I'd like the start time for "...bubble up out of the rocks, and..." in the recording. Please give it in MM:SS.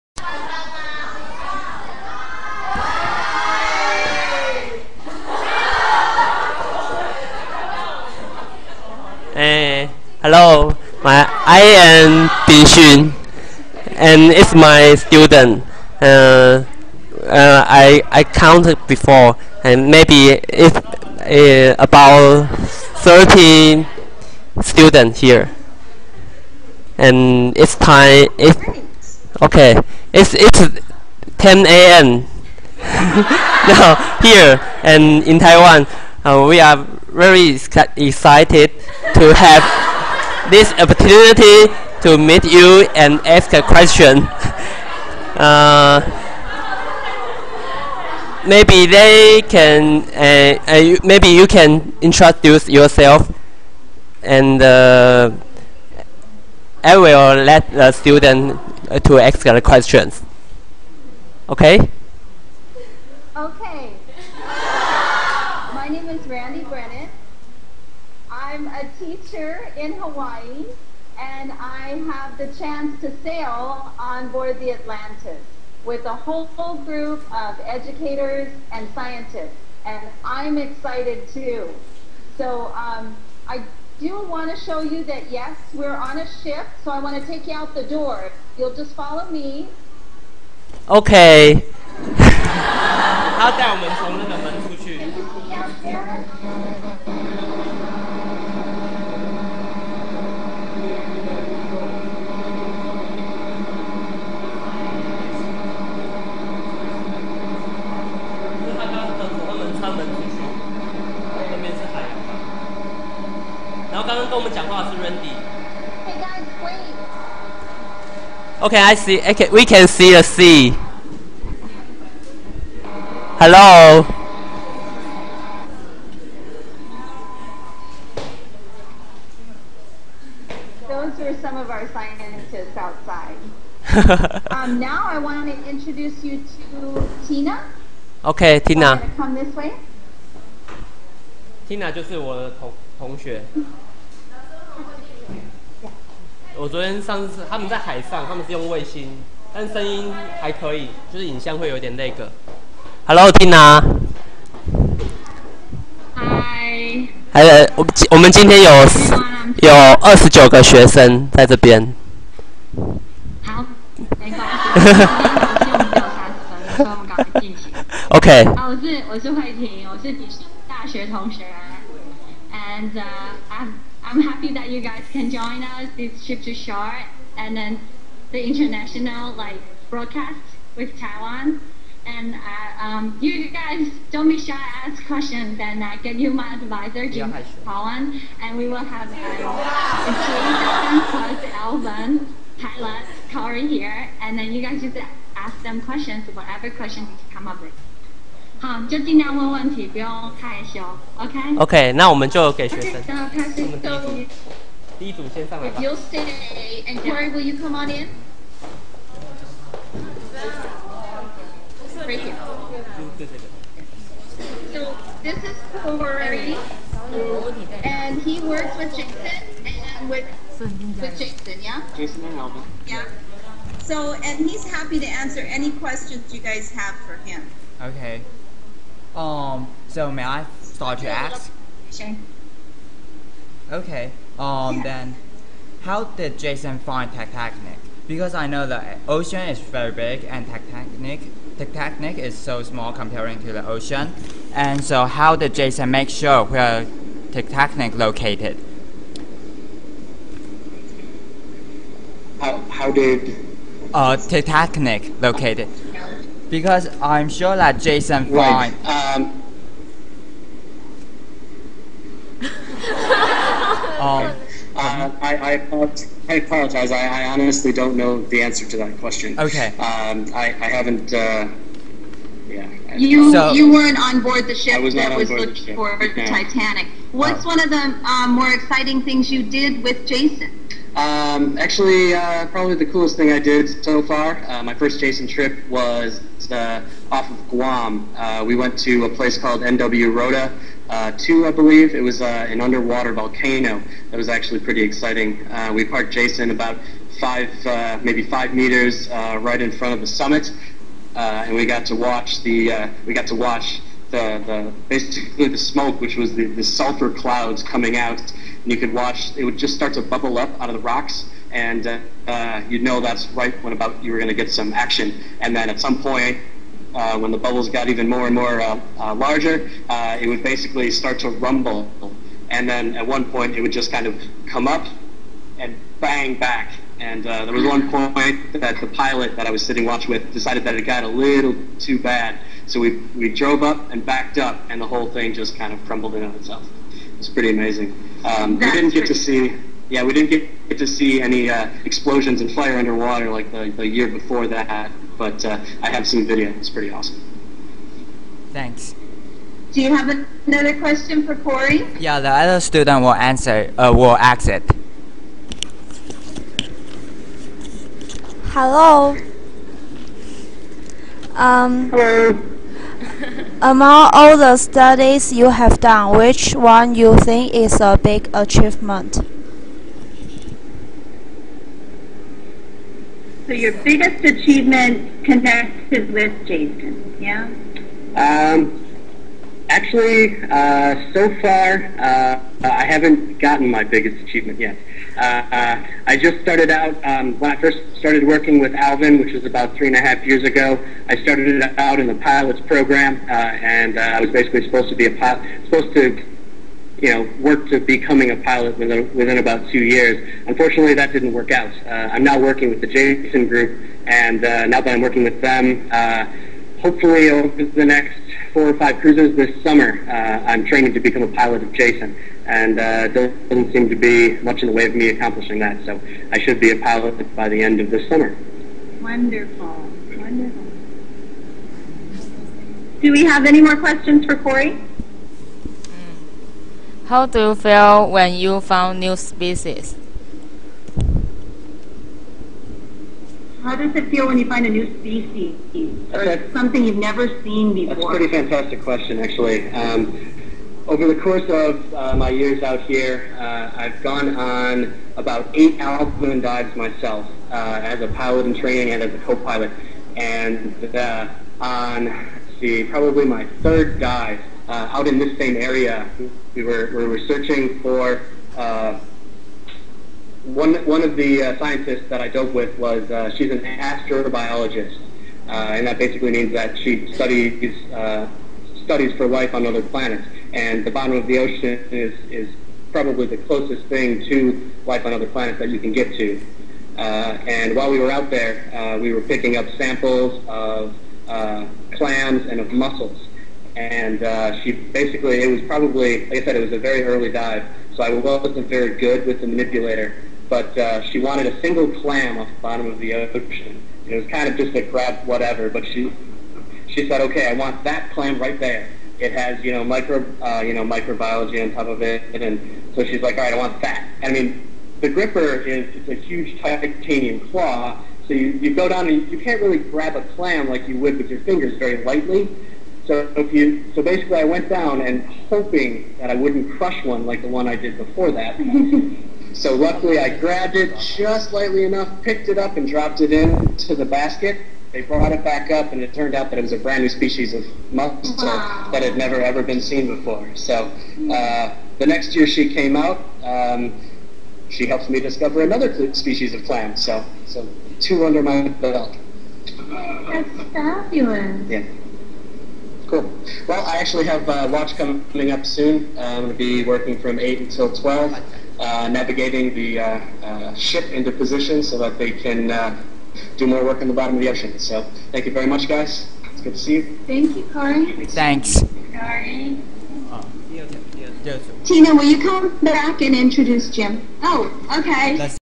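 05:10.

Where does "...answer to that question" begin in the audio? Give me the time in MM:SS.
04:28.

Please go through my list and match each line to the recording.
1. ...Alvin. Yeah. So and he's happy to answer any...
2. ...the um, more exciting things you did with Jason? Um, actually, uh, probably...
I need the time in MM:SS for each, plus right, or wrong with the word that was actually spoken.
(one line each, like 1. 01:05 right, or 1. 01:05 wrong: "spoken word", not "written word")
1. 03:42 right
2. 04:37 right.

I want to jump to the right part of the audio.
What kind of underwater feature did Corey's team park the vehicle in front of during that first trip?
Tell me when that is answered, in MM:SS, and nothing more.
04:52.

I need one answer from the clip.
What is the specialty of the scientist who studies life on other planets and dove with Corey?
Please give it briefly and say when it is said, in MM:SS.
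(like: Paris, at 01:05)
Astrobiologist, at 07:43.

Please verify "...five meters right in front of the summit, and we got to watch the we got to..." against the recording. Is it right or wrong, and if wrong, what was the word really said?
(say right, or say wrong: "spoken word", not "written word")
right.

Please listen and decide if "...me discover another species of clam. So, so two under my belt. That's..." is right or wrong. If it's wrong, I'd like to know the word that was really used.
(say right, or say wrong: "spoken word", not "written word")
right.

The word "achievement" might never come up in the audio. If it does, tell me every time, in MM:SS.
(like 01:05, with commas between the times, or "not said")
06:08, 06:14, 06:24.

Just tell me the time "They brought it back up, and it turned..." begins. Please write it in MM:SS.
08:44.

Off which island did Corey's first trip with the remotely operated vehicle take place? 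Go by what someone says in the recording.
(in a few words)
Guam.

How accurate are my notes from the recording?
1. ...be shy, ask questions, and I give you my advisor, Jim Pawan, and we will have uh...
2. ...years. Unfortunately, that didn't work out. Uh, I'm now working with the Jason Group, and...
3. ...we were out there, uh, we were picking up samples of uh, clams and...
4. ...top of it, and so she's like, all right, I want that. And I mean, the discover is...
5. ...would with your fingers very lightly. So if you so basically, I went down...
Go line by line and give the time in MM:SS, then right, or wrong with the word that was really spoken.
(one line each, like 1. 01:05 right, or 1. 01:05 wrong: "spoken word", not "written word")
1. 03:04 right
2. 06:39 right
3. 07:57 right
4. 08:21 wrong: "gripper", not "discover"
5. 08:30 right.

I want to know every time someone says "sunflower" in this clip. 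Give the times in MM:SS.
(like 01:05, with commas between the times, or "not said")
not said.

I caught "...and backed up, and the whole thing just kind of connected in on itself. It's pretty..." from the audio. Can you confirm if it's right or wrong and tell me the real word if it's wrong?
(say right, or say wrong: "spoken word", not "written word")
wrong: "crumbled", not "connected".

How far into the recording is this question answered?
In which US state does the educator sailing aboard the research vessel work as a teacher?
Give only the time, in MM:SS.
01:09.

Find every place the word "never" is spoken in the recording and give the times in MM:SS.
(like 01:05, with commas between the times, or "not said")
07:16, 08:49.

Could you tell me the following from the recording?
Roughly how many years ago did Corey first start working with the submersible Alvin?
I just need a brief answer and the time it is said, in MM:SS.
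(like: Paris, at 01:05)
3 and a half years, at 06:29.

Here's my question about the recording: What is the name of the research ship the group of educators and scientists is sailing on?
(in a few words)
Atlantis.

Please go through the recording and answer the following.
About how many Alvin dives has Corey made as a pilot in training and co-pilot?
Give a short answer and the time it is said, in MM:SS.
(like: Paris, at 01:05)
8, at 07:25.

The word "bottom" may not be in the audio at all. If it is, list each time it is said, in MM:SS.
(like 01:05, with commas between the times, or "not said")
07:50, 08:12, 09:14.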